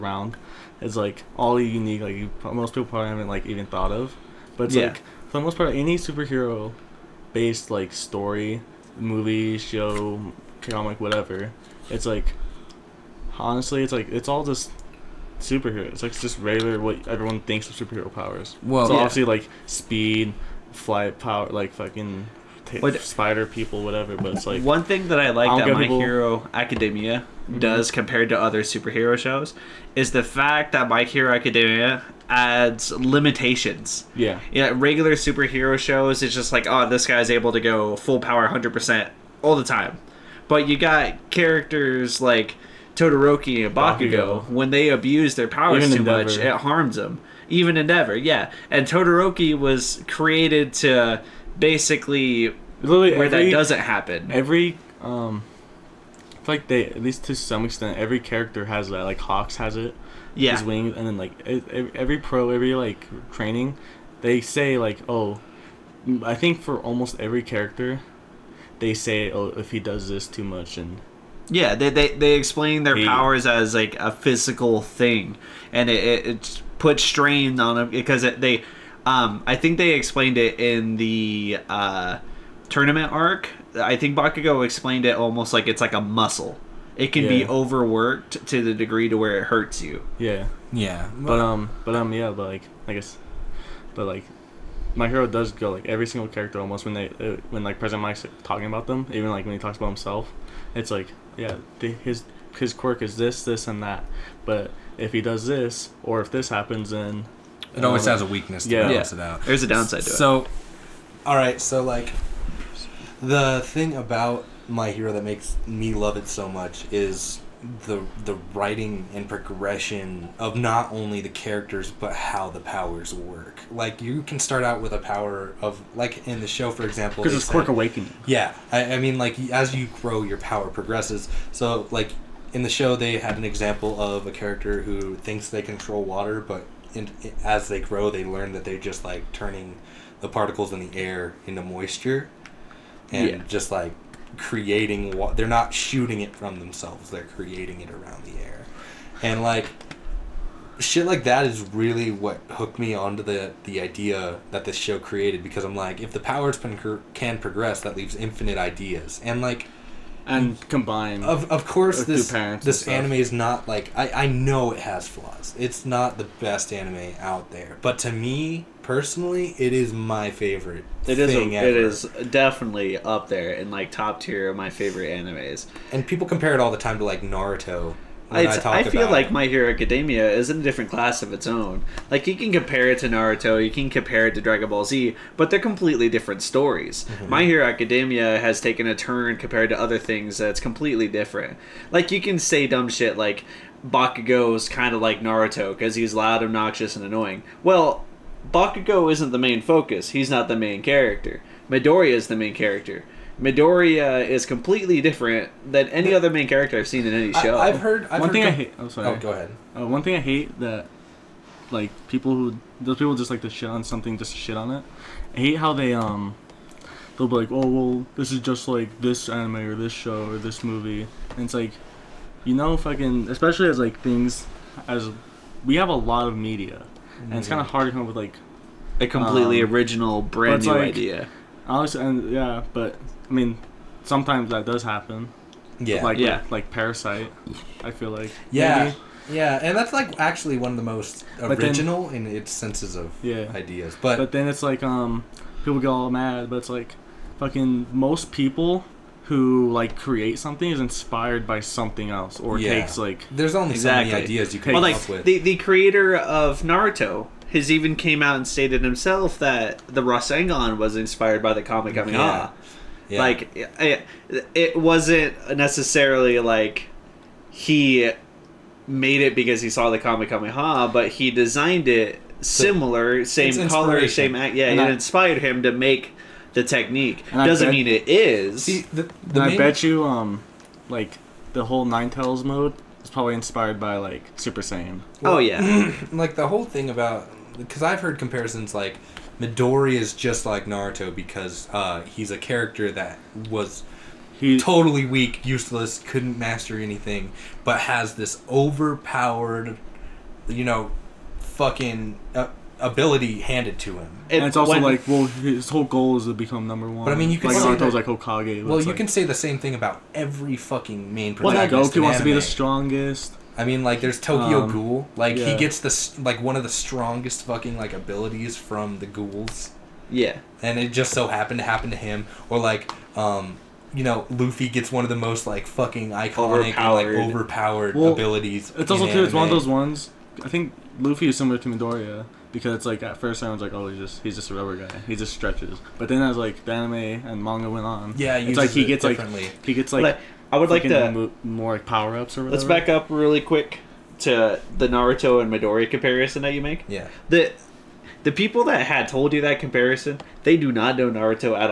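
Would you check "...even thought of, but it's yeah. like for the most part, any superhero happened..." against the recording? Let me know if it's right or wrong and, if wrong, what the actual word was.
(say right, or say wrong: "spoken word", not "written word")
wrong: "based", not "happened".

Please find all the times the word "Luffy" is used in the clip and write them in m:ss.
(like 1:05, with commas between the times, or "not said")
5:24, 5:30.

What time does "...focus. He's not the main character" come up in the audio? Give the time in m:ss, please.
3:19.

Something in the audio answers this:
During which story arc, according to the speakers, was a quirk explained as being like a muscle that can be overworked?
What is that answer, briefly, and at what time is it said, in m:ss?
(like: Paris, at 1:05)
tournament arc, at 1:22.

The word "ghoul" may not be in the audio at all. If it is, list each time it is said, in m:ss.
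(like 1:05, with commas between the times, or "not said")
5:14, 5:19.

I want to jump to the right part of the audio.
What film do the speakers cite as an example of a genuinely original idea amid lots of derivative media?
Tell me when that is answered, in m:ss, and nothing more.
3:56.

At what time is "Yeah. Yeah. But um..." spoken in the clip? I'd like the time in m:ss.
1:30.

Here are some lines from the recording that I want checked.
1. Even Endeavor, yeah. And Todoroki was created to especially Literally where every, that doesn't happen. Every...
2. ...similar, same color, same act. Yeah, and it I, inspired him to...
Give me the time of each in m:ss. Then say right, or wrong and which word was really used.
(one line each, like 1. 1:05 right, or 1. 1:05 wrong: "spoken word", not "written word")
1. 0:47 wrong: "basically", not "especially"
2. 4:32 right.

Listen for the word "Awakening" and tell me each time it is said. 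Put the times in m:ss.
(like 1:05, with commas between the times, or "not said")
2:07.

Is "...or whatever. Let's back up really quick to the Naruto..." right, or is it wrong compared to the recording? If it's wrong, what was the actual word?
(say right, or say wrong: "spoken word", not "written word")
right.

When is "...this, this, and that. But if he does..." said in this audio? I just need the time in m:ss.
1:43.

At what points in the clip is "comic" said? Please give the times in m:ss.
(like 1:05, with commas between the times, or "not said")
0:10, 4:21, 4:29.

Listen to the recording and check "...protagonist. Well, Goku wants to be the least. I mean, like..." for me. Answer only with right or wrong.
wrong.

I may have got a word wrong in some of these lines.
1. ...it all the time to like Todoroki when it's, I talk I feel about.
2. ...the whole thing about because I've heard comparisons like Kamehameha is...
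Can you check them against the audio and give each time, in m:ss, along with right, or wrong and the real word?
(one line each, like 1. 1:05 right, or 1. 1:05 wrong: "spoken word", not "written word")
1. 2:56 wrong: "Naruto", not "Todoroki"
2. 4:46 wrong: "Midori", not "Kamehameha".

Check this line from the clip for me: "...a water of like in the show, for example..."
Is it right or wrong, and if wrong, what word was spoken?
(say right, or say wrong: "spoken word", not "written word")
wrong: "power", not "water".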